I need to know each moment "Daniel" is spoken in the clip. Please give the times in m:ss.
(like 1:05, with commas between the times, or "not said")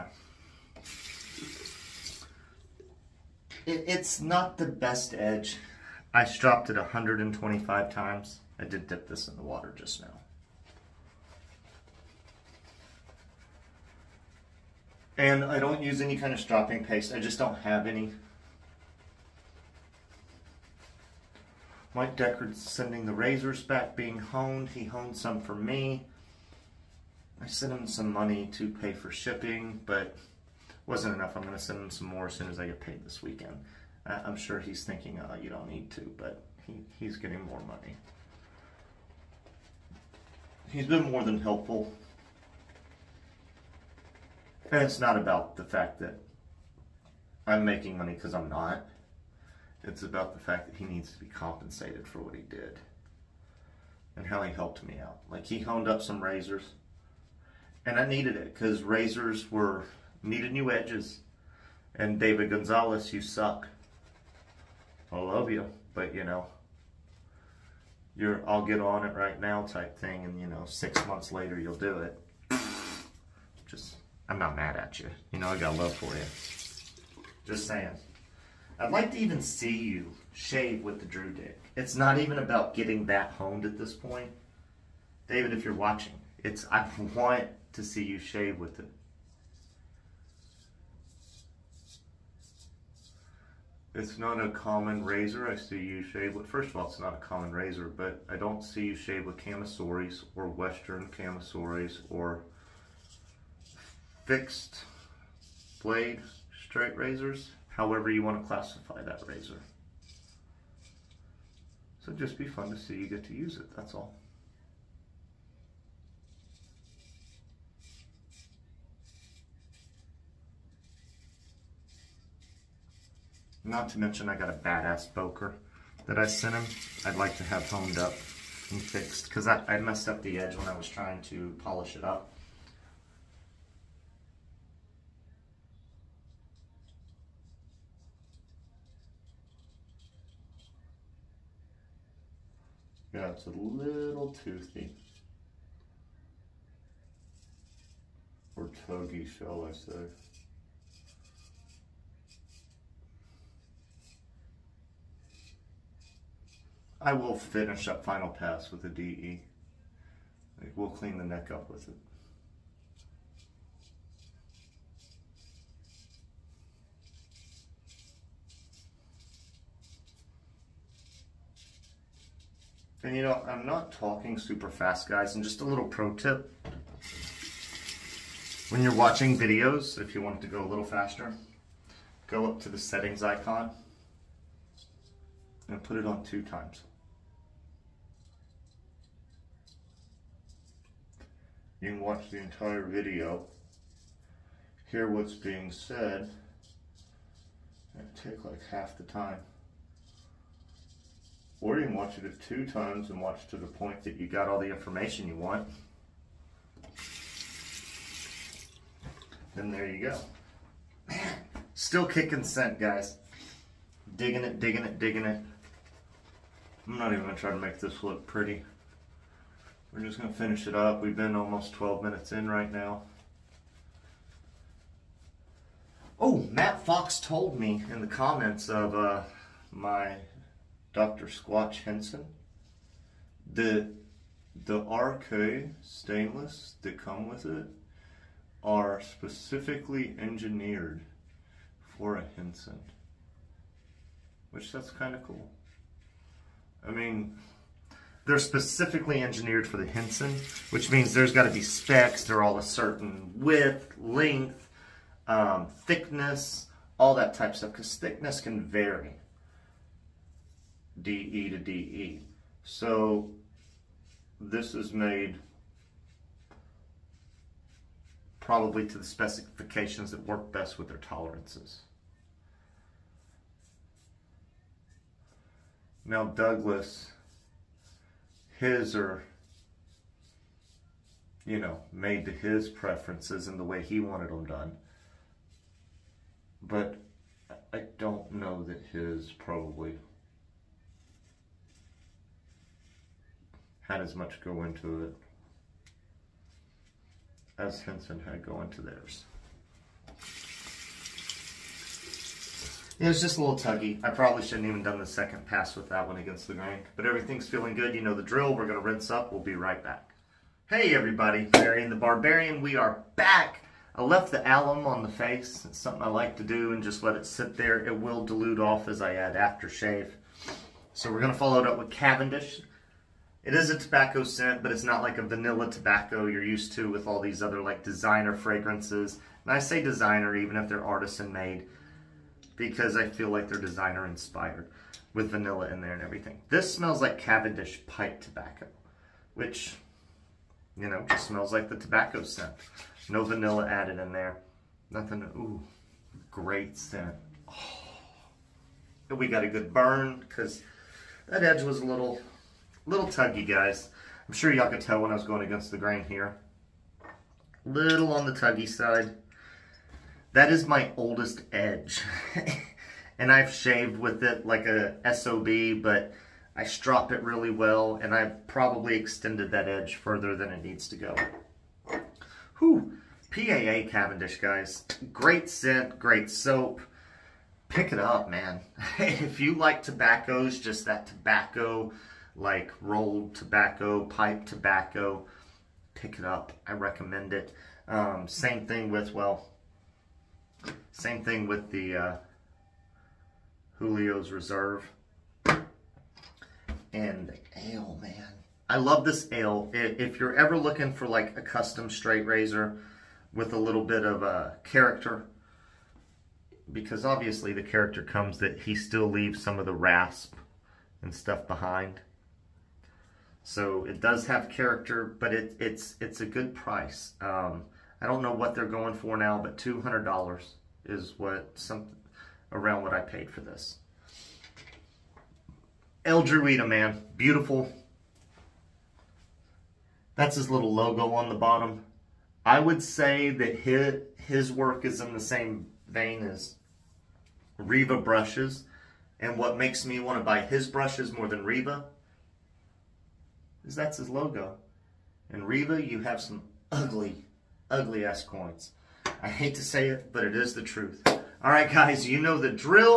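not said.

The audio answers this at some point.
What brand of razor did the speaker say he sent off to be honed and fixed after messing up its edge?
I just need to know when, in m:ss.
2:05.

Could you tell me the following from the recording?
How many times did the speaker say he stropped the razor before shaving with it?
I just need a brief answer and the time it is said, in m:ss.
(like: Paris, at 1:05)
125, at 0:06.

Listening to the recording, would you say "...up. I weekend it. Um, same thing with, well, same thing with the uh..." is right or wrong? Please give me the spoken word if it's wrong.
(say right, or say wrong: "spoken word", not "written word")
wrong: "recommend", not "weekend".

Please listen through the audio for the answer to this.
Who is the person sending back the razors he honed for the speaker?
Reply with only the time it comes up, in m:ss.
0:21.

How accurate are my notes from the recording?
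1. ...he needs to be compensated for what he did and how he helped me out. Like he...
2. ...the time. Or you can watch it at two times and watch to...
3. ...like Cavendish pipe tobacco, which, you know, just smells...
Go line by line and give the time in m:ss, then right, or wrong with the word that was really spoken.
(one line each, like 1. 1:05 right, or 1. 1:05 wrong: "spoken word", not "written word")
1. 0:50 right
2. 3:18 right
3. 5:36 right.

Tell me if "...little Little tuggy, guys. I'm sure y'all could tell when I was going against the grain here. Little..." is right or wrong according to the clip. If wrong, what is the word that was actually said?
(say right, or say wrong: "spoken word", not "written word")
right.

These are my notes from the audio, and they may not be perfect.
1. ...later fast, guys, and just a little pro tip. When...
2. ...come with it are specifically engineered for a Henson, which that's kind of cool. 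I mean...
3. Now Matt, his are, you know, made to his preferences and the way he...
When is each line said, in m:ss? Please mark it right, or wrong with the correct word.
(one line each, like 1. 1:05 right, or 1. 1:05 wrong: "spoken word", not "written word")
1. 2:54 wrong: "super", not "later"
2. 3:56 right
3. 4:36 wrong: "Douglas", not "Matt".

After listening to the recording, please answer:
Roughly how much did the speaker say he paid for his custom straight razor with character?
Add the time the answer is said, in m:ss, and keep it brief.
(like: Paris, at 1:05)
$200, at 6:59.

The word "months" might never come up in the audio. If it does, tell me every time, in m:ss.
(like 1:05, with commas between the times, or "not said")
1:11.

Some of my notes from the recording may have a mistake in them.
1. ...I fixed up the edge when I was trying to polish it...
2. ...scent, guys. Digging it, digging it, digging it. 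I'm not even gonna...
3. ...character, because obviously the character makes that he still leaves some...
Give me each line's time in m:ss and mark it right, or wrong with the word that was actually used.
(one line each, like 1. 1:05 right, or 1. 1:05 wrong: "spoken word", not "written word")
1. 2:09 wrong: "messed", not "fixed"
2. 3:32 right
3. 6:44 wrong: "comes", not "makes".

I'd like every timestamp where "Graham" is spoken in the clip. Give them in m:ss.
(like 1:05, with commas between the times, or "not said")
not said.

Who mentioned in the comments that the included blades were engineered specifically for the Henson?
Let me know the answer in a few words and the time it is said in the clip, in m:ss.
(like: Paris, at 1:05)
Matt Fox, at 3:46.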